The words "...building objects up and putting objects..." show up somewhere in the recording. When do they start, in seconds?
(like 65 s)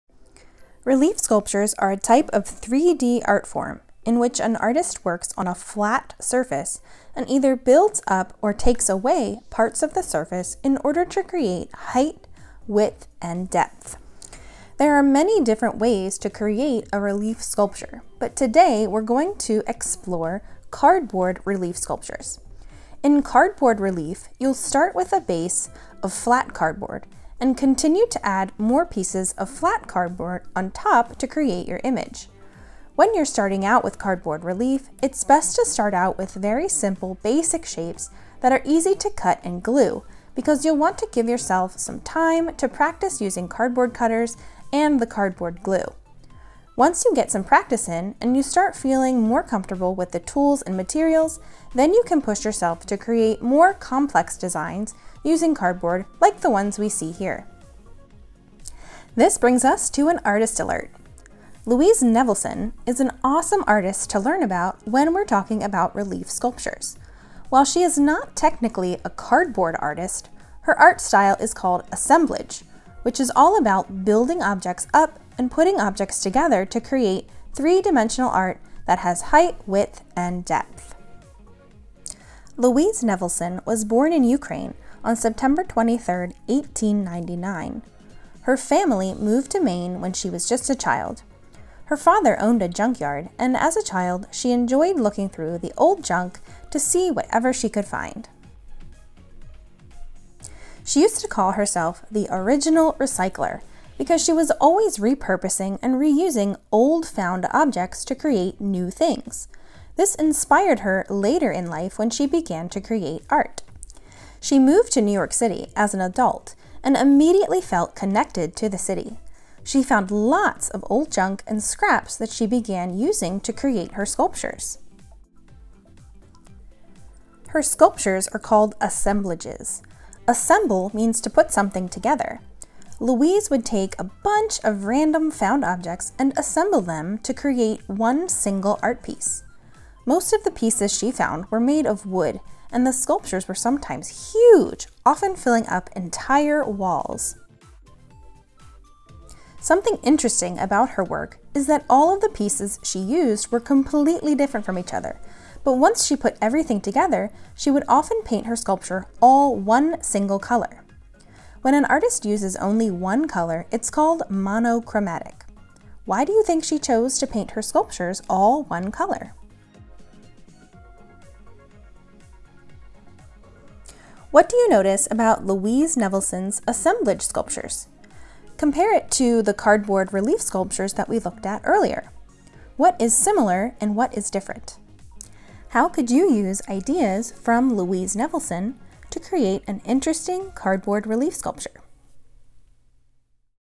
74 s.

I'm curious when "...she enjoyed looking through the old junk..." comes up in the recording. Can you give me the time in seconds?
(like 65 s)
94 s.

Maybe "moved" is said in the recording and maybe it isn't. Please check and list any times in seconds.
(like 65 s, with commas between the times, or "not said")
89 s, 114 s.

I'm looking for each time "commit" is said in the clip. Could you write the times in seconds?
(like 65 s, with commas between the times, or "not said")
not said.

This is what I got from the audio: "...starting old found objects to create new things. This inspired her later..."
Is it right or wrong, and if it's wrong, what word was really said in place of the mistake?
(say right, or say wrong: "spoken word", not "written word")
wrong: "reusing", not "starting".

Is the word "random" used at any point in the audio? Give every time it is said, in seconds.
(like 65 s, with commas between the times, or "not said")
134 s.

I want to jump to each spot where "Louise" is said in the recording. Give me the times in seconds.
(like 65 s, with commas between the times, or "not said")
61 s, 82 s, 133 s, 175 s, 187 s.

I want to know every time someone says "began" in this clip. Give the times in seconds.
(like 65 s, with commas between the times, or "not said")
112 s, 122 s.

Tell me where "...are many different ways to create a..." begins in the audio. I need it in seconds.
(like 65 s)
14 s.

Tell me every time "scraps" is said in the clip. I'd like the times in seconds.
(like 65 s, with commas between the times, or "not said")
121 s.